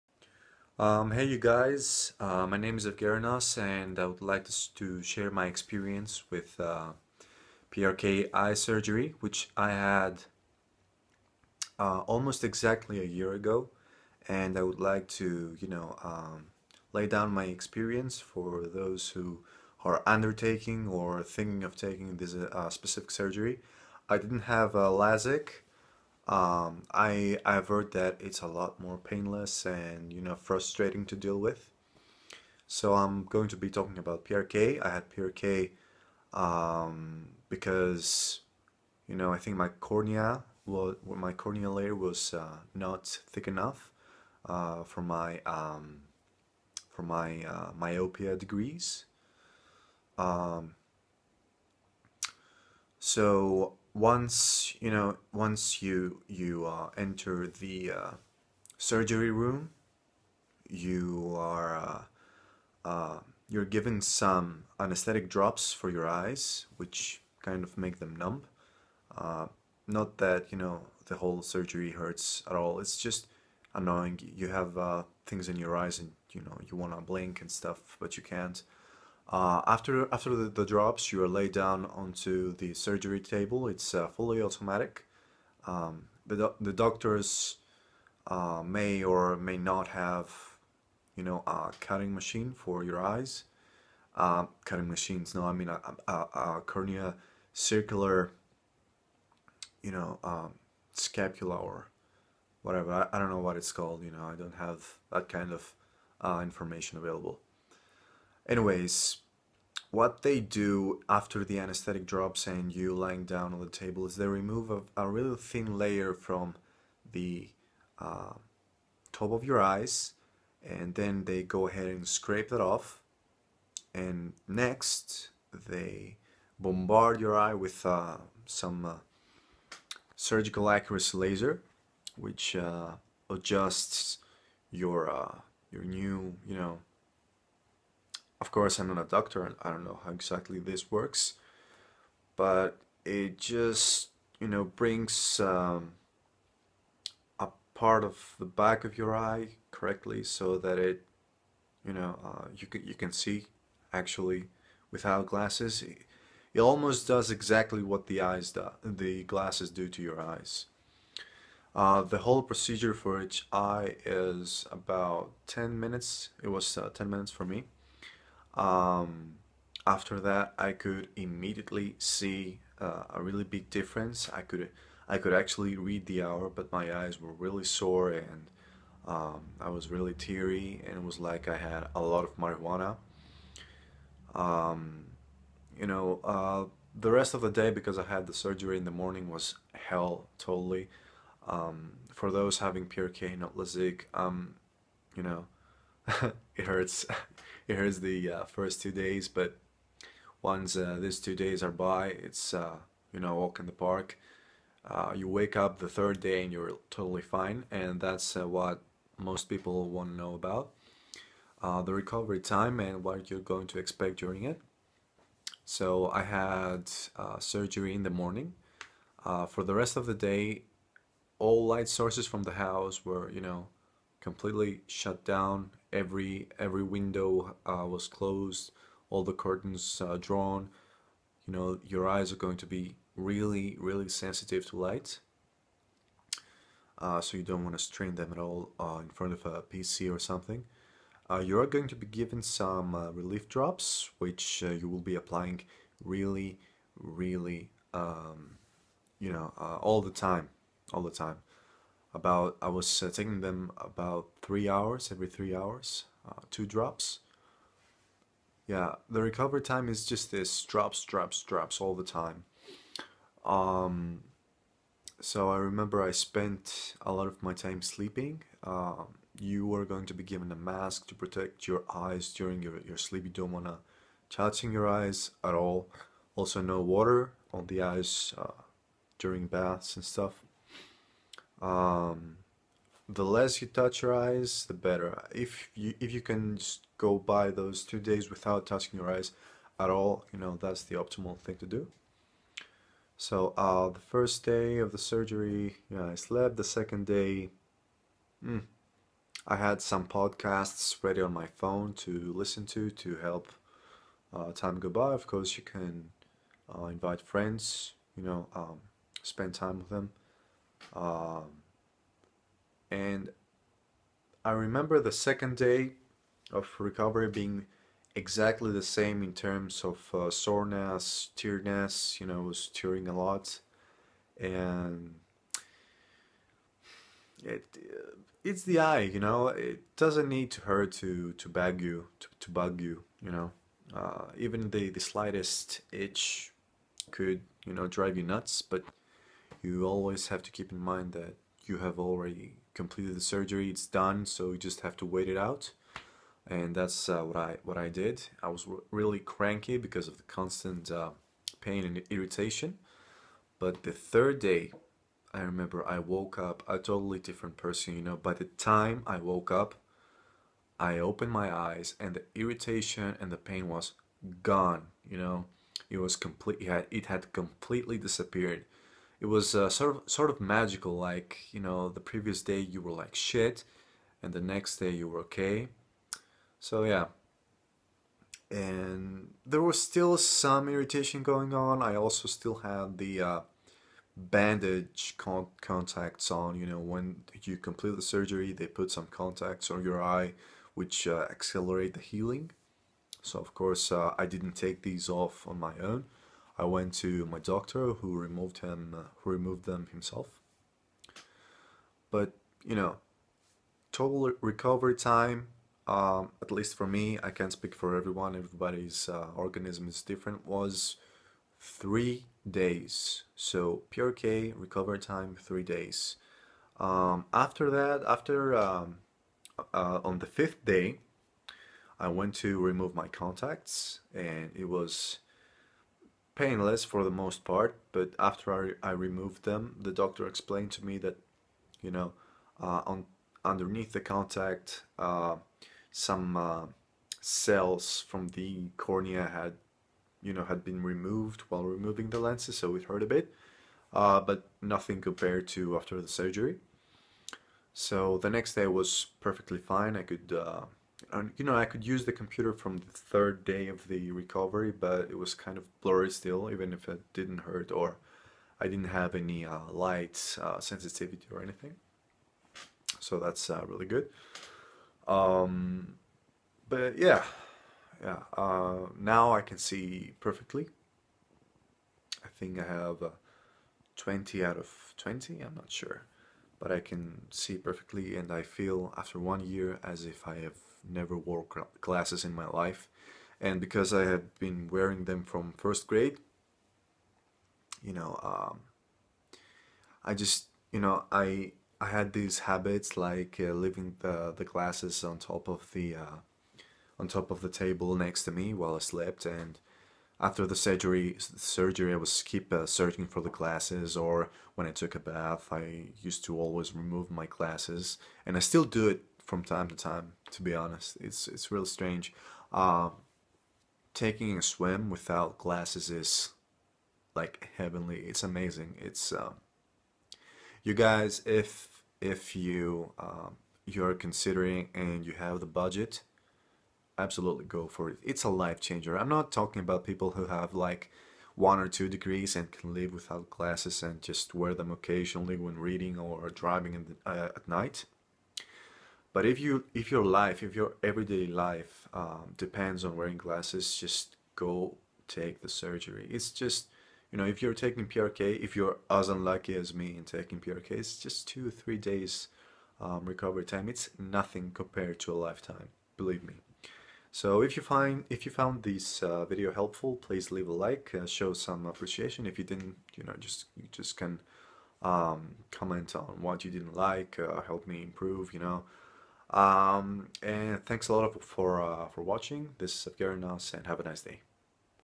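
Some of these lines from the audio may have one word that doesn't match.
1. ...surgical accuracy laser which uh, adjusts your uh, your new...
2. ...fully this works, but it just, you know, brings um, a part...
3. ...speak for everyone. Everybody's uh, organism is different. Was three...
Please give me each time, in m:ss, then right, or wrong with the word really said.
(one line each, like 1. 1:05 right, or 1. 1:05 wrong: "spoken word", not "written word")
1. 2:10 right
2. 2:20 wrong: "exactly", not "fully"
3. 6:47 right.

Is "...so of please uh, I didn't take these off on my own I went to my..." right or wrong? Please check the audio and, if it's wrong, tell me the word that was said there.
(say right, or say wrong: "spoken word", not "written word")
wrong: "course", not "please".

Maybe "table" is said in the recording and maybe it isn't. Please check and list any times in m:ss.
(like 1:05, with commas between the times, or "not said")
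1:23, 1:53, 8:17.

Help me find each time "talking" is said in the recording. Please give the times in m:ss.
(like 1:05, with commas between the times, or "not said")
0:33, 8:49.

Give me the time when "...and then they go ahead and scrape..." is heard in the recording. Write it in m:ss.
2:00.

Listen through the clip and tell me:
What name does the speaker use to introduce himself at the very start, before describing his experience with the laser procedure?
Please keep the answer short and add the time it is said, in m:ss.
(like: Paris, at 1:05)
Evgerinos, at 0:02.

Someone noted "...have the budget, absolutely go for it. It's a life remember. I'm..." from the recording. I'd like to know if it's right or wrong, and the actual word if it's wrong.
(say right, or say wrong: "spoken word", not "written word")
wrong: "changer", not "remember".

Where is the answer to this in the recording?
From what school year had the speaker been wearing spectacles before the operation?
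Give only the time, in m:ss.
8:05.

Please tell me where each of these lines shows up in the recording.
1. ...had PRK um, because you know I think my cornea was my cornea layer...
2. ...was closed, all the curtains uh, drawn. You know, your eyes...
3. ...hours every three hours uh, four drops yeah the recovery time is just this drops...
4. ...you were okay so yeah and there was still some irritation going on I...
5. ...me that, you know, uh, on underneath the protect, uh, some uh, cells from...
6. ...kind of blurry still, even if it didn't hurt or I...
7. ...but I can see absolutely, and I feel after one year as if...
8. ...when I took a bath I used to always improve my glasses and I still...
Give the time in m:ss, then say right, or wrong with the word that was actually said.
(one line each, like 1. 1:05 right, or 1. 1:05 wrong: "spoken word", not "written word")
1. 0:34 right
2. 3:47 right
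3. 4:14 wrong: "two", not "four"
4. 6:14 right
5. 7:10 wrong: "contact", not "protect"
6. 7:35 right
7. 7:56 wrong: "perfectly", not "absolutely"
8. 8:24 wrong: "remove", not "improve".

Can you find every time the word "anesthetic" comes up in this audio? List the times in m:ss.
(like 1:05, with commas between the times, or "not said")
1:04, 1:51.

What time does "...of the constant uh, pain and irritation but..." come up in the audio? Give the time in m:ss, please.
5:50.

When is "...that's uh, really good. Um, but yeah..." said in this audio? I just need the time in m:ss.
7:43.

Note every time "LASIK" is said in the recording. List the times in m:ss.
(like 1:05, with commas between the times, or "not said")
0:24, 3:13.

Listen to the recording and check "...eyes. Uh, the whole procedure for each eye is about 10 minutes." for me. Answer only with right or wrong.
right.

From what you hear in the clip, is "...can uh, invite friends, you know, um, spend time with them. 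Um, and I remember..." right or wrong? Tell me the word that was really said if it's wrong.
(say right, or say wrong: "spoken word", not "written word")
right.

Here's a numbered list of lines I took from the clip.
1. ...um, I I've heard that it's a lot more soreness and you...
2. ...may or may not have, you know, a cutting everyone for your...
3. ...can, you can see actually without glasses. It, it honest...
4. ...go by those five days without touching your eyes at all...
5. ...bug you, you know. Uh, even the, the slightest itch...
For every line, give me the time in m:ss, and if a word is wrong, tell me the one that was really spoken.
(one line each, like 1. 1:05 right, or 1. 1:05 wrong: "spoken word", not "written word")
1. 0:26 wrong: "painless", not "soreness"
2. 1:28 wrong: "machine", not "everyone"
3. 2:32 wrong: "almost", not "honest"
4. 4:46 wrong: "two", not "five"
5. 5:32 right.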